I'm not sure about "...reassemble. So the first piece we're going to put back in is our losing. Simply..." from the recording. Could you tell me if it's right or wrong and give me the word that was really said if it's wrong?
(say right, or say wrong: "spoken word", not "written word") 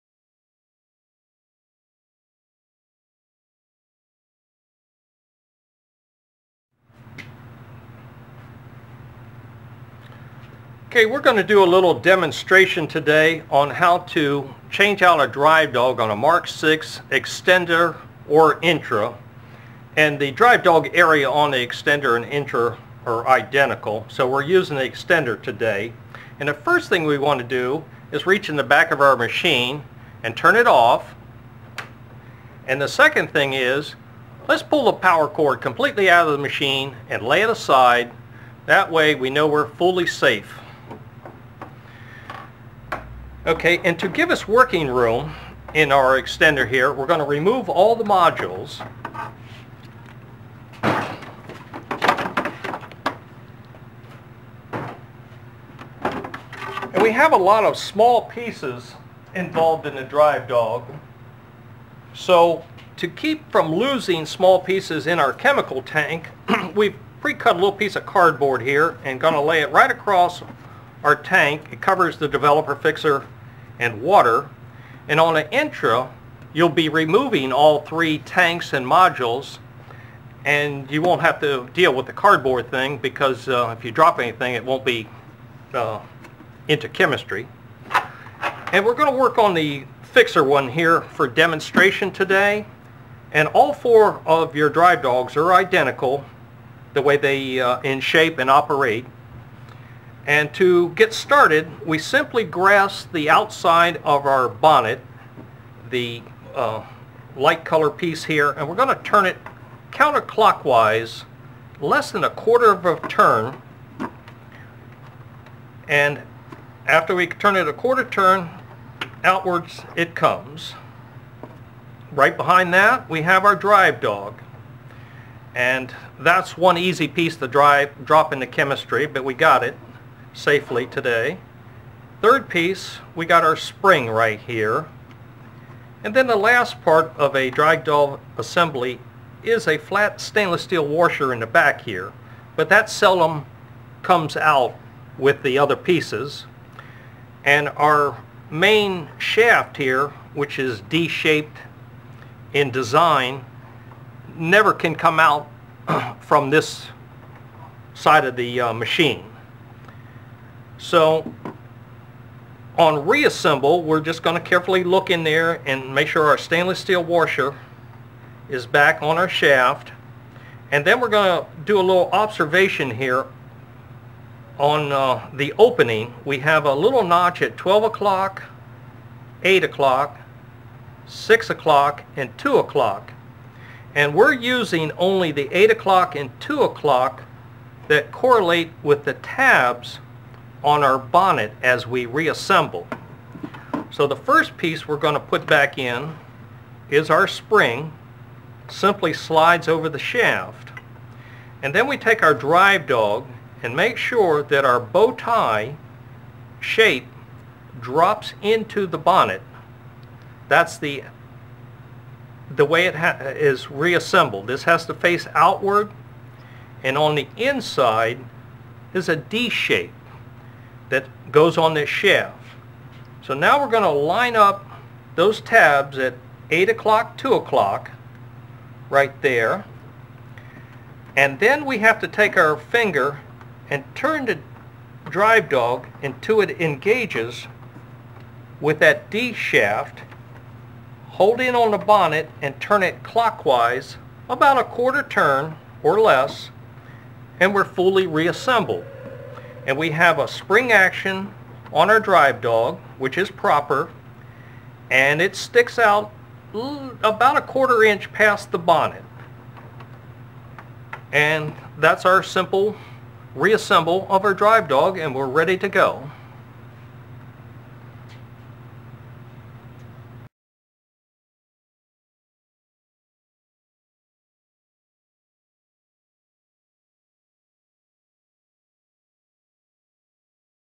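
wrong: "spring", not "losing".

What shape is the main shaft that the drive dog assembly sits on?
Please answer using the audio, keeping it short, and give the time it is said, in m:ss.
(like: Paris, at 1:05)
D-shaped, at 2:30.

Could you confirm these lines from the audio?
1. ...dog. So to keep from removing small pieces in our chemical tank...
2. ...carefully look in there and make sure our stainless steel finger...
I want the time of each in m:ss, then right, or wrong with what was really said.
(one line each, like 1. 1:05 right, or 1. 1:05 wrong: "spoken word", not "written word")
1. 1:00 wrong: "losing", not "removing"
2. 2:44 wrong: "washer", not "finger".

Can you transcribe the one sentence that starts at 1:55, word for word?
And after we turn it a quarter turn, outwards it comes.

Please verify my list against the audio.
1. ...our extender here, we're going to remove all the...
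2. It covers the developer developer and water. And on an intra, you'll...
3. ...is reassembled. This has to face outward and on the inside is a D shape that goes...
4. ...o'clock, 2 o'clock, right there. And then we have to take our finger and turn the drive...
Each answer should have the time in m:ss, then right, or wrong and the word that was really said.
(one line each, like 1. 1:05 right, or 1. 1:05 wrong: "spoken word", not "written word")
1. 0:45 right
2. 1:11 wrong: "fixer", not "developer"
3. 3:33 right
4. 3:46 right.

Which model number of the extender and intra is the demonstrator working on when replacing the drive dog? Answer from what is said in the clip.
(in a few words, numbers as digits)
Mark 6.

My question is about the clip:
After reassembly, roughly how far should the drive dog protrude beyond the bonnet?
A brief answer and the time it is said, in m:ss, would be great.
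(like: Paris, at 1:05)
a quarter inch, at 4:17.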